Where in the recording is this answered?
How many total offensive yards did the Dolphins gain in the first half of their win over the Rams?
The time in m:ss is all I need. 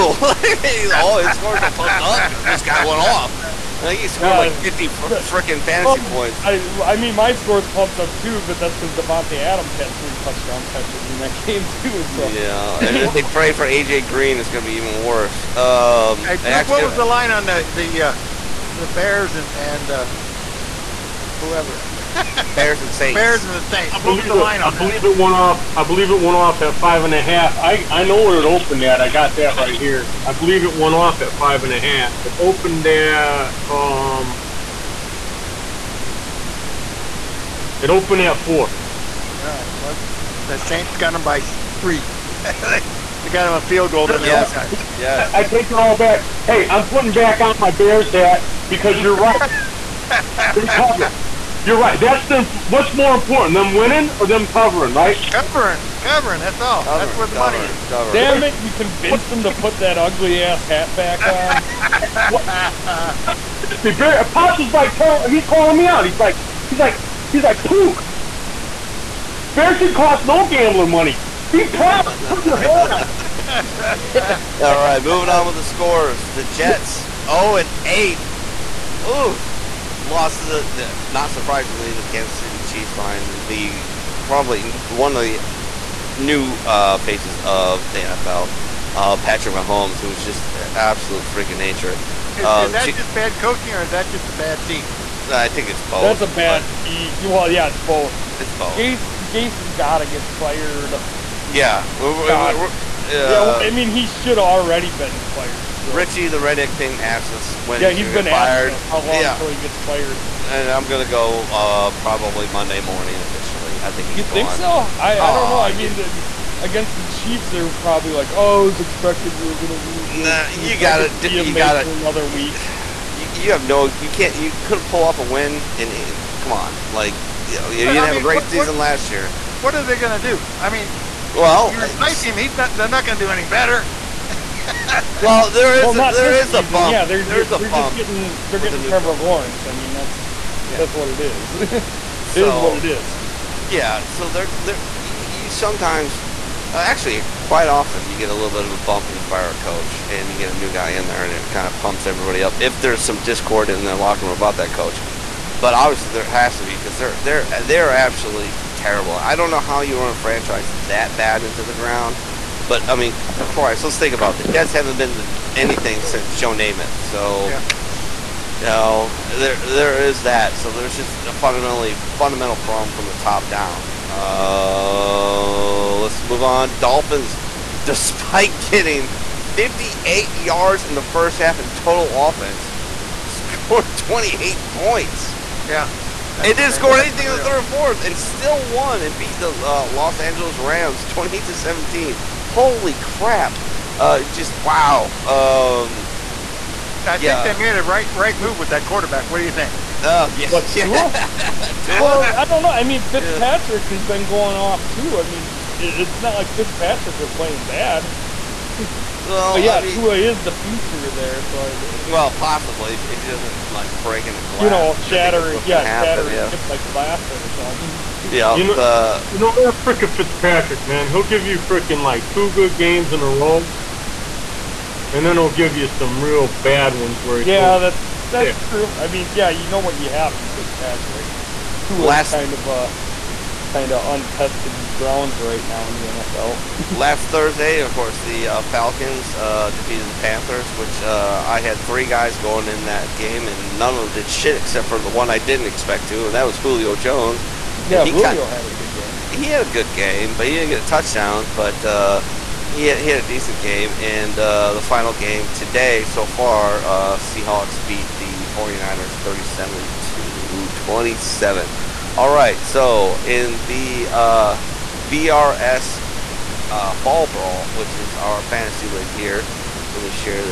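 2:59.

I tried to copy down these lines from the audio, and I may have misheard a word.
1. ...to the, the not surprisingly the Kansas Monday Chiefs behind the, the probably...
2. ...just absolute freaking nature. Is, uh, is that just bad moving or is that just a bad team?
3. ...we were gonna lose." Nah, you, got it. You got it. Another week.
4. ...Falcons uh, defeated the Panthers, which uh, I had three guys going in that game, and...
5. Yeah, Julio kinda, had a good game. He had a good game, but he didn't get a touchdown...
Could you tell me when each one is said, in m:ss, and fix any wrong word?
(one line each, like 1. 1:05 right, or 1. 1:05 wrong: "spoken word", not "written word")
1. 1:20 wrong: "City", not "Monday"
2. 1:30 wrong: "coaching", not "moving"
3. 1:59 right
4. 3:58 right
5. 4:07 right.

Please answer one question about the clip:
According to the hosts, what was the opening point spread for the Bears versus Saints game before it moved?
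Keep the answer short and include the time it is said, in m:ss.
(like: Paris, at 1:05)
4, at 0:38.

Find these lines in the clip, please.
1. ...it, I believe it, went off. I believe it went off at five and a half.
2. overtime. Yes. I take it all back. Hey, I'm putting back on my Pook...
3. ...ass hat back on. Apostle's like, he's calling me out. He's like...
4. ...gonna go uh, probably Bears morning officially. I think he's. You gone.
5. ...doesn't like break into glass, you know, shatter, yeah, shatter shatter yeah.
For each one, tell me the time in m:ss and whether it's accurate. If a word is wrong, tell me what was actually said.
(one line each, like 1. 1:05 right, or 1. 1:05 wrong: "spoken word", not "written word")
1. 0:24 right
2. 0:44 wrong: "Bears", not "Pook"
3. 1:00 right
4. 1:50 wrong: "Monday", not "Bears"
5. 3:33 right.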